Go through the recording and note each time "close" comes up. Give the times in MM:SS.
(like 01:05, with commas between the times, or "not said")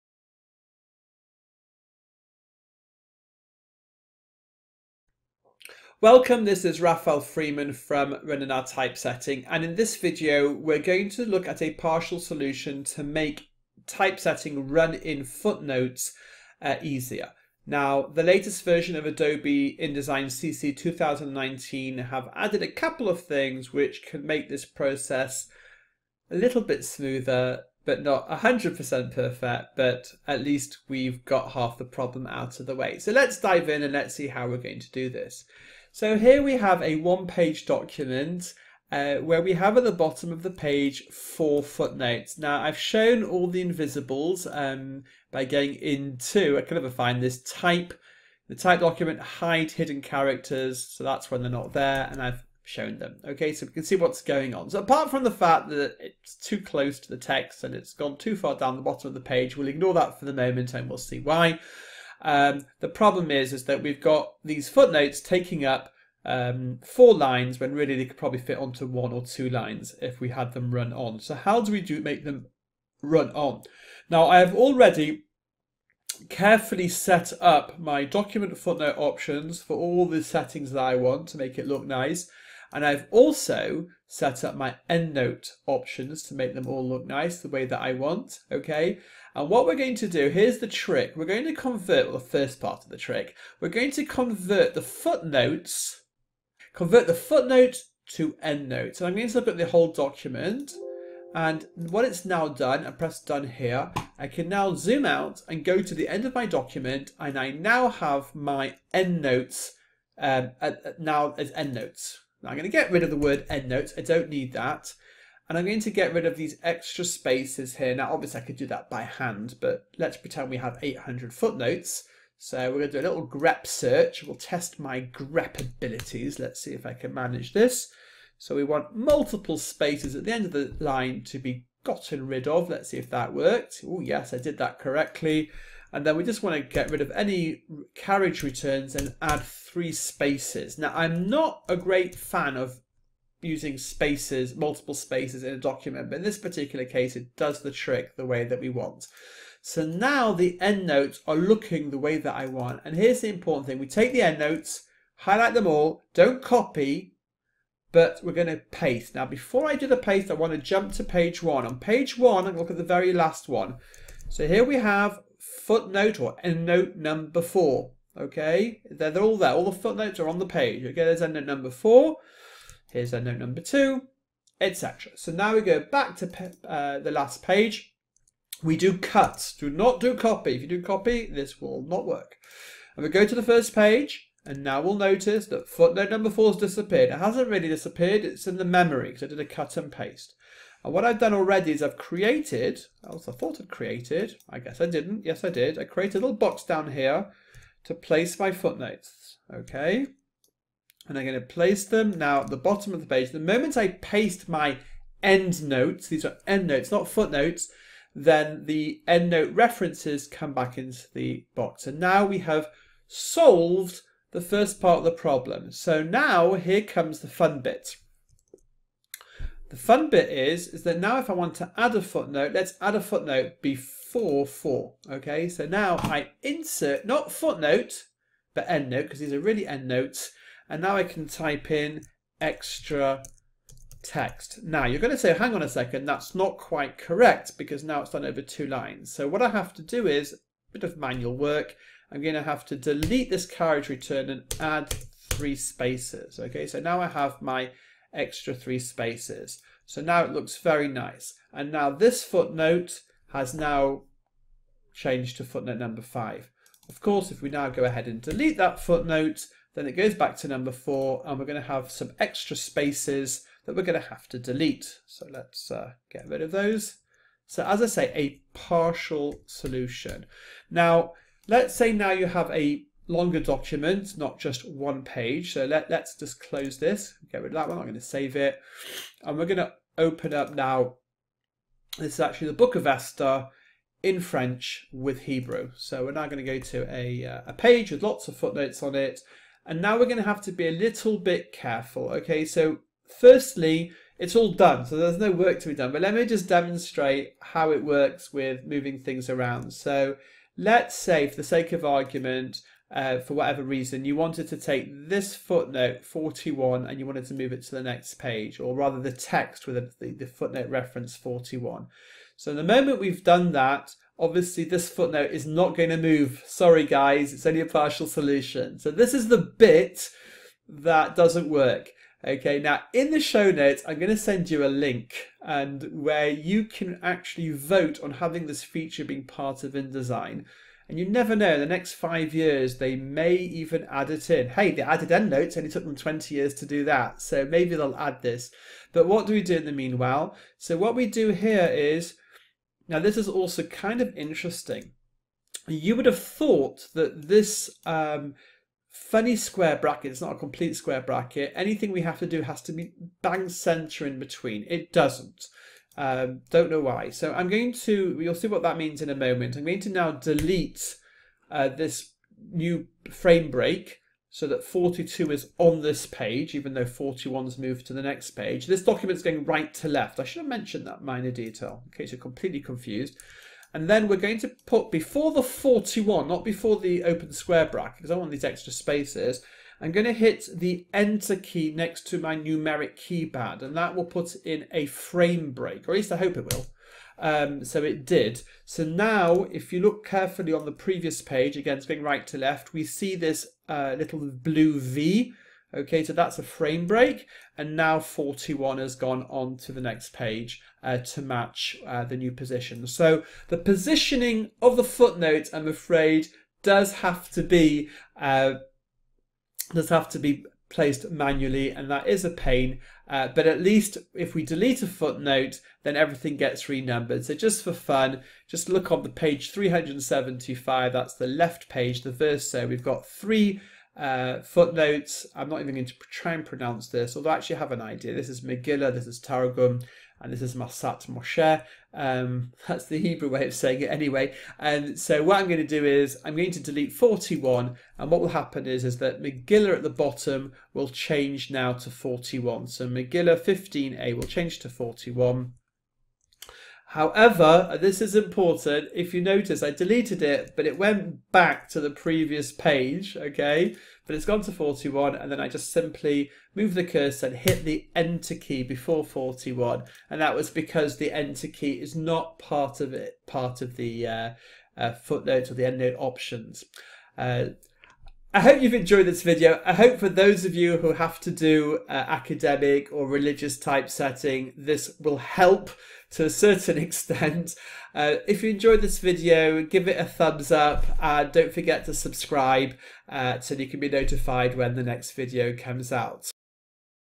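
00:56, 04:36.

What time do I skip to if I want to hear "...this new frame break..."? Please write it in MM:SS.
06:01.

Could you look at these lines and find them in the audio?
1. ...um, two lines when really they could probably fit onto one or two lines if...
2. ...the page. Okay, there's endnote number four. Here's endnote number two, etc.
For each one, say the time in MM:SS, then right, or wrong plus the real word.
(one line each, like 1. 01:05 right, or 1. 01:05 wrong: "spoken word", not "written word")
1. 01:06 wrong: "four", not "two"
2. 02:50 right.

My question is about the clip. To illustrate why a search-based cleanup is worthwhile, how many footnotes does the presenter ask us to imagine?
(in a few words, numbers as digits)
800.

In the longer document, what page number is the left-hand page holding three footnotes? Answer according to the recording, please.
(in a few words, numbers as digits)
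375.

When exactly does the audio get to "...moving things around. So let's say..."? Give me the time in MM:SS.
04:58.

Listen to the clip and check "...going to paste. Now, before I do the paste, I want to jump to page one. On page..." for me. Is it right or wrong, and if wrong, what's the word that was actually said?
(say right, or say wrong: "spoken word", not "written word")
right.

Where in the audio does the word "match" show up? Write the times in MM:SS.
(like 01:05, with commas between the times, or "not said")
06:41.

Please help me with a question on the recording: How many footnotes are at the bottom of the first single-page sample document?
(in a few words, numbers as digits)
4.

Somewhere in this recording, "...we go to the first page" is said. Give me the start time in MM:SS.
03:03.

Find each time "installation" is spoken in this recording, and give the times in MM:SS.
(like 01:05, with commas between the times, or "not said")
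not said.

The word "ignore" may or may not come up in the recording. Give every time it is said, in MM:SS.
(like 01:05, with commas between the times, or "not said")
00:59.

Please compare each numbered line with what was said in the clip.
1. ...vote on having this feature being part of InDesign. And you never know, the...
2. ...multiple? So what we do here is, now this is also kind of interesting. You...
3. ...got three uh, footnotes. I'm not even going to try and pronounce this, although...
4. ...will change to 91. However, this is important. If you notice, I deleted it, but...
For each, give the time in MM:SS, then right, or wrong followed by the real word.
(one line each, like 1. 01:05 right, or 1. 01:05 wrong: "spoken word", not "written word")
1. 05:27 right
2. 05:39 wrong: "meanwhile", not "multiple"
3. 07:02 right
4. 07:24 wrong: "41", not "91".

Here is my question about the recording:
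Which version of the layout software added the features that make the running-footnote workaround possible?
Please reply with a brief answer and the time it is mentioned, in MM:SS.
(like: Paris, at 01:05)
Adobe InDesign CC 2019, at 00:19.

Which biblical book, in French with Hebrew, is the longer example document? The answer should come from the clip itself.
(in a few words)
Book of Esther.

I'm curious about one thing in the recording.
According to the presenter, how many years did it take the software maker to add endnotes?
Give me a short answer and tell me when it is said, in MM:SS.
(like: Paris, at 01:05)
20, at 05:35.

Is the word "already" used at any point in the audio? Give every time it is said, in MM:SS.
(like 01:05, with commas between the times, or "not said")
01:14, 03:11.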